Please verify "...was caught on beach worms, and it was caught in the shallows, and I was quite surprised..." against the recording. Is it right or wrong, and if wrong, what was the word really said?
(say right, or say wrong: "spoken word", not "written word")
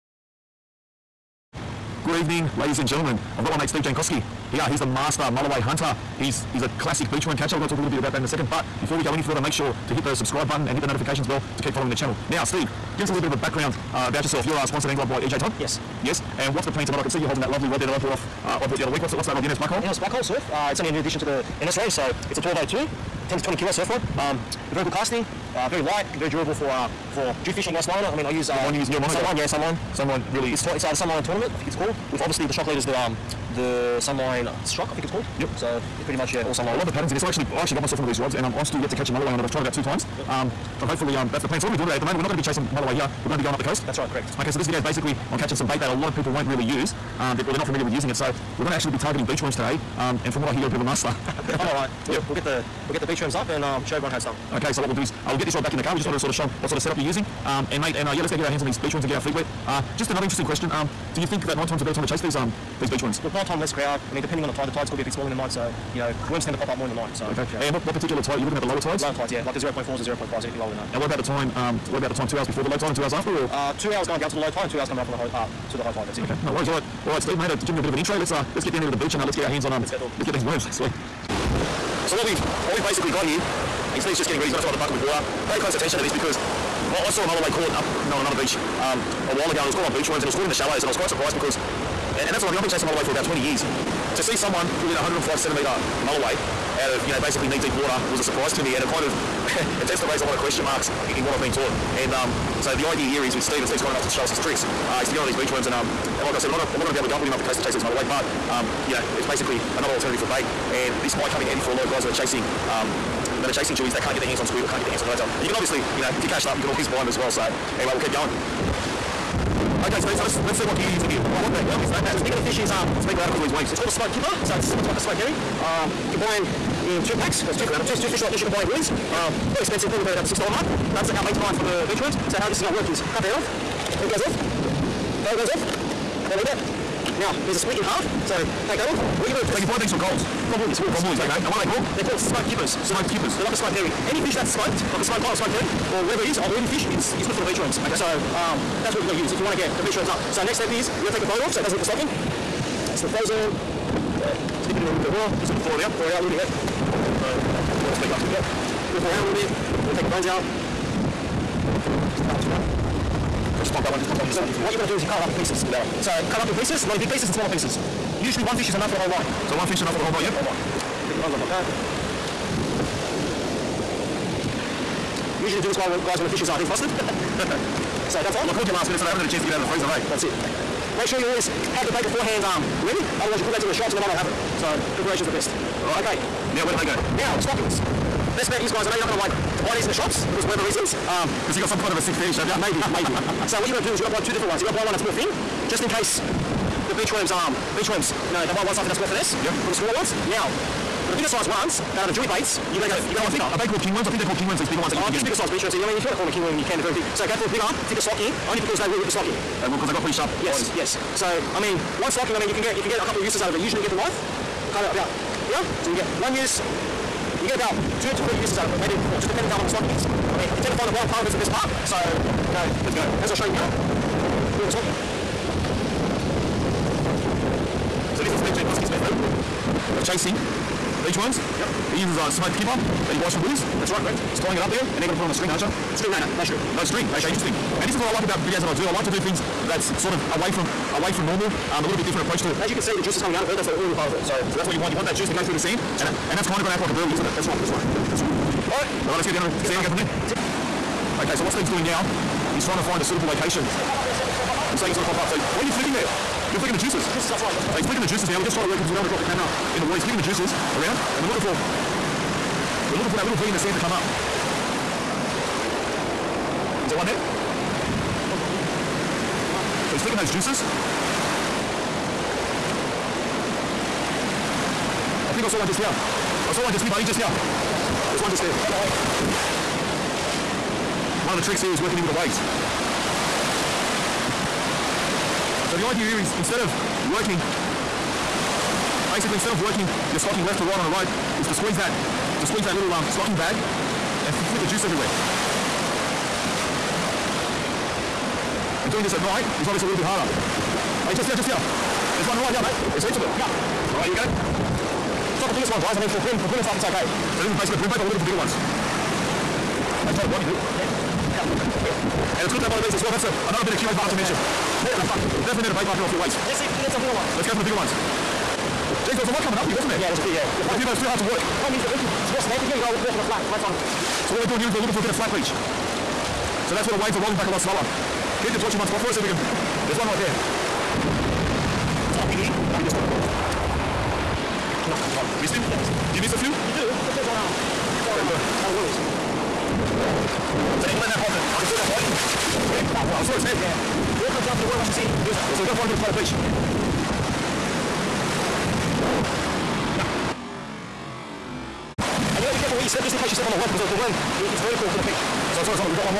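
right.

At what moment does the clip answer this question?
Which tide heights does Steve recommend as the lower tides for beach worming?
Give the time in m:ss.
1:09.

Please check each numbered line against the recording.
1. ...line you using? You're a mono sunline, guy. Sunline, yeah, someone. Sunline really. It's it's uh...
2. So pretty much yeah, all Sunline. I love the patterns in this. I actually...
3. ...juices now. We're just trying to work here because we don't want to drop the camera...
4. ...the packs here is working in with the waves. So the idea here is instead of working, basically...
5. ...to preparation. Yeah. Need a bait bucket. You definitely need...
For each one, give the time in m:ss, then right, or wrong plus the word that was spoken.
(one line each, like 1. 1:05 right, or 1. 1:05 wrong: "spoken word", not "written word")
1. 0:28 wrong: "sunline", not "someone"
2. 0:35 right
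3. 4:18 right
4. 4:41 wrong: "tricks", not "packs"
5. 5:14 wrong: "mention", not "preparation".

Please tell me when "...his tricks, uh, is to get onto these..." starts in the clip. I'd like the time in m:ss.
1:44.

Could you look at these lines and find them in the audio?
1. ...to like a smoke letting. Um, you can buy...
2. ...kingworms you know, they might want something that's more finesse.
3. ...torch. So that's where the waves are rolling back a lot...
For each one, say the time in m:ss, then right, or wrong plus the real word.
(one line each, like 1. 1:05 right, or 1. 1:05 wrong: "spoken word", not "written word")
1. 2:04 wrong: "herring", not "letting"
2. 3:17 wrong: "worms", not "kingworms"
3. 5:25 wrong: "beach", not "torch".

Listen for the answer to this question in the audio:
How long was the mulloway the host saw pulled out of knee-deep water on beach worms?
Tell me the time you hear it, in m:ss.
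1:34.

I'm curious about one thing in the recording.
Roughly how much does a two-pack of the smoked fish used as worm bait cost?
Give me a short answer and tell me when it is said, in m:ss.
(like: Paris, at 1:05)
$6, at 2:10.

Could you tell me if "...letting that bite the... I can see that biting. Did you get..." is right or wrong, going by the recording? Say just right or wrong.
right.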